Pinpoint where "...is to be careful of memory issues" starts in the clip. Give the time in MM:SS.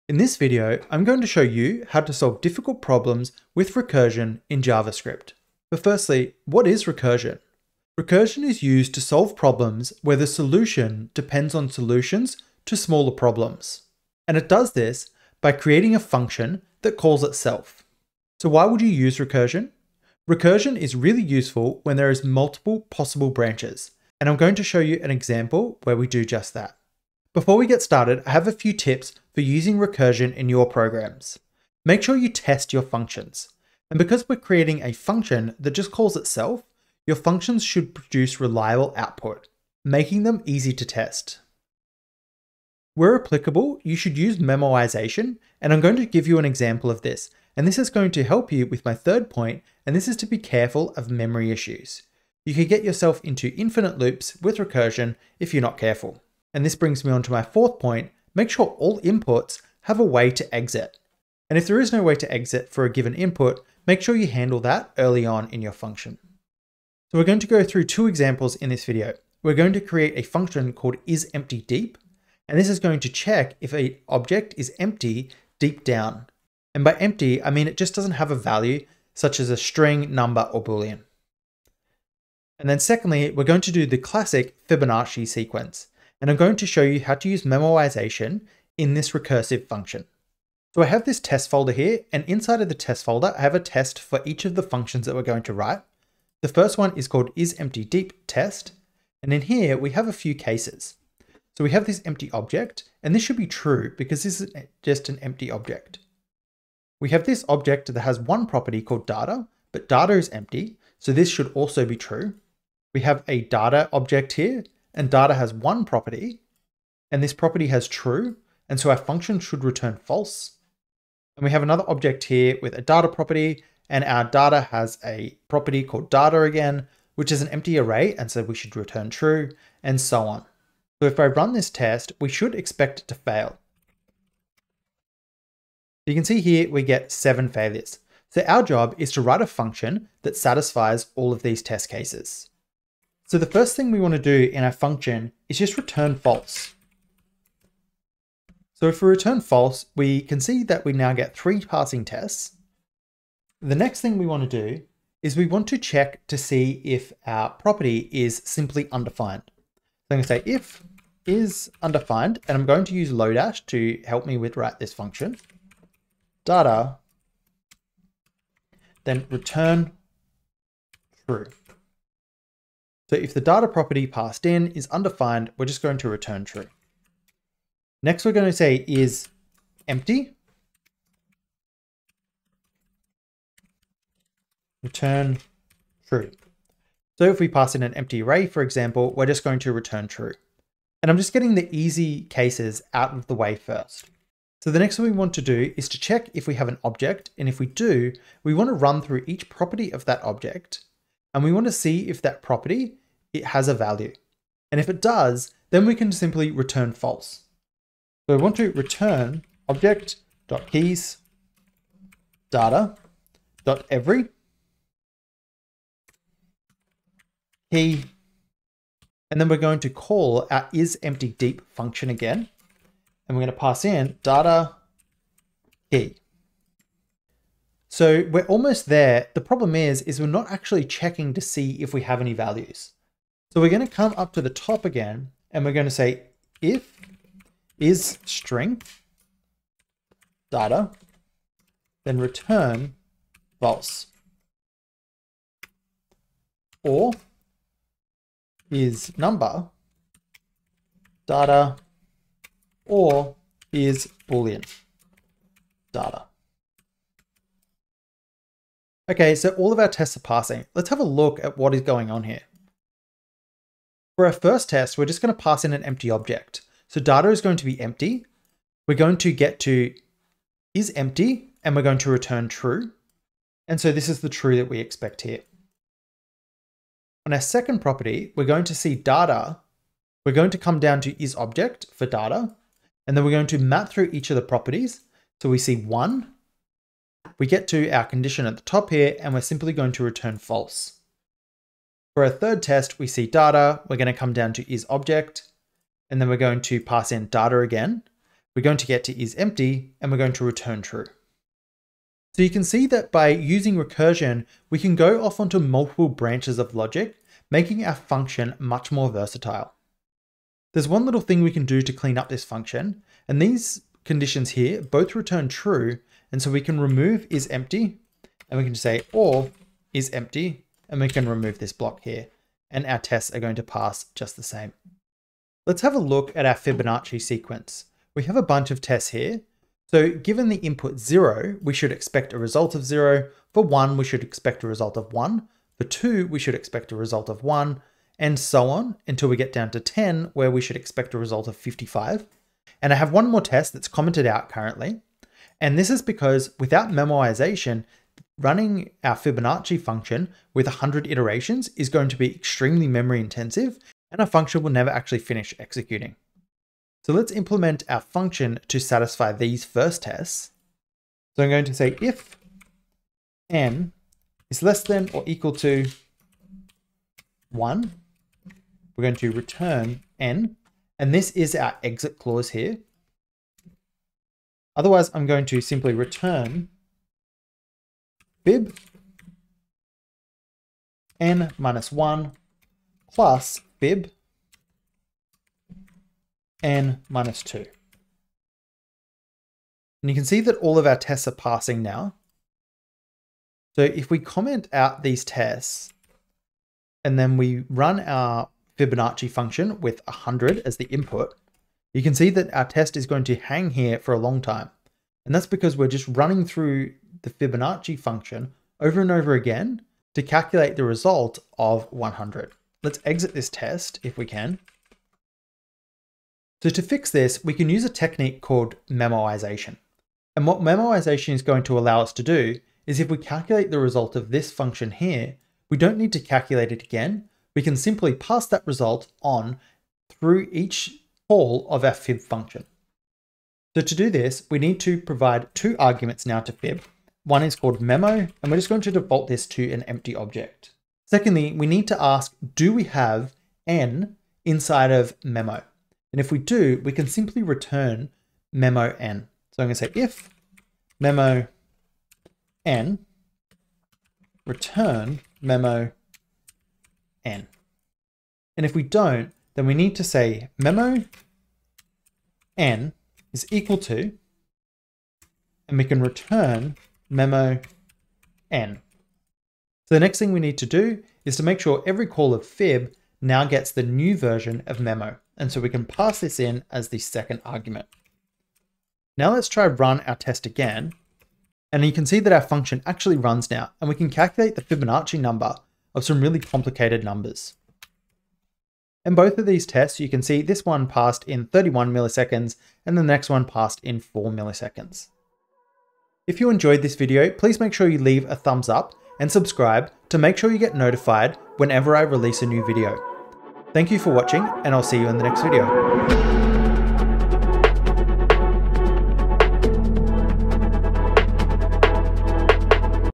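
00:50.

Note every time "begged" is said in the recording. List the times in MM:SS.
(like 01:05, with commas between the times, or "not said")
not said.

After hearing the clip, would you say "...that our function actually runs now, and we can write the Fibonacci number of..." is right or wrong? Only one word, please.
wrong.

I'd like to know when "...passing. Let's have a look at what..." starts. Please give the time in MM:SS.
04:20.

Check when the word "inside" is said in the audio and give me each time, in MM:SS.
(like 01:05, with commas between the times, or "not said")
01:32, 07:24.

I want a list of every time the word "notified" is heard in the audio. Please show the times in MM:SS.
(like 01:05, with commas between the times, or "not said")
08:20.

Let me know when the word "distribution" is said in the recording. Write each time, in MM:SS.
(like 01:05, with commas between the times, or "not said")
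not said.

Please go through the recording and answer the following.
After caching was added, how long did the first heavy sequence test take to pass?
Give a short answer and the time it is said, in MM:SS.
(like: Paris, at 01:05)
31 milliseconds, at 08:11.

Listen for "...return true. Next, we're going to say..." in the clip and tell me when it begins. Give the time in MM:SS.
02:56.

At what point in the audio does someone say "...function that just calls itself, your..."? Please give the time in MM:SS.
00:34.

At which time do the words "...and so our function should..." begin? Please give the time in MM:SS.
01:58.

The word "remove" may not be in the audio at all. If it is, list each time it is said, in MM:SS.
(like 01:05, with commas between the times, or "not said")
05:16, 05:21.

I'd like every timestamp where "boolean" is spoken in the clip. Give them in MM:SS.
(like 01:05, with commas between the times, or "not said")
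01:20, 04:14.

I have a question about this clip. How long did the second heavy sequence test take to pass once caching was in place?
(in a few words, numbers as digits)
4 milliseconds.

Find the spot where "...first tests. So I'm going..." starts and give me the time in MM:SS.
05:59.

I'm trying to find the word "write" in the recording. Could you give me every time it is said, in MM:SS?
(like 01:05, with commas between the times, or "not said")
01:35, 02:19, 02:44.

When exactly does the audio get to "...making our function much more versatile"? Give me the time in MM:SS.
05:07.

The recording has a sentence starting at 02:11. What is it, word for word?
So if I run this test, we should expect it to fail.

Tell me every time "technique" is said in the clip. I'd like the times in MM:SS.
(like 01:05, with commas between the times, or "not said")
06:57.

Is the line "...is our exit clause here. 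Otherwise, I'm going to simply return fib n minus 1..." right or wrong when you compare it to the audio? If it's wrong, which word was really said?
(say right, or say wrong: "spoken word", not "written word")
right.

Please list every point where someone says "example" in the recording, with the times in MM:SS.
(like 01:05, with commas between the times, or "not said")
00:25, 00:46, 01:08, 03:08.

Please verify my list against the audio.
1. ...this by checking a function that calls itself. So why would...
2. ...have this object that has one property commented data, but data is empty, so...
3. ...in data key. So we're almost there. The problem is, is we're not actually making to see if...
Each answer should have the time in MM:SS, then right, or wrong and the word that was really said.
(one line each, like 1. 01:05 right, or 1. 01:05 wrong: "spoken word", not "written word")
1. 00:14 wrong: "creating", not "checking"
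2. 01:47 wrong: "called", not "commented"
3. 03:43 wrong: "checking", not "making".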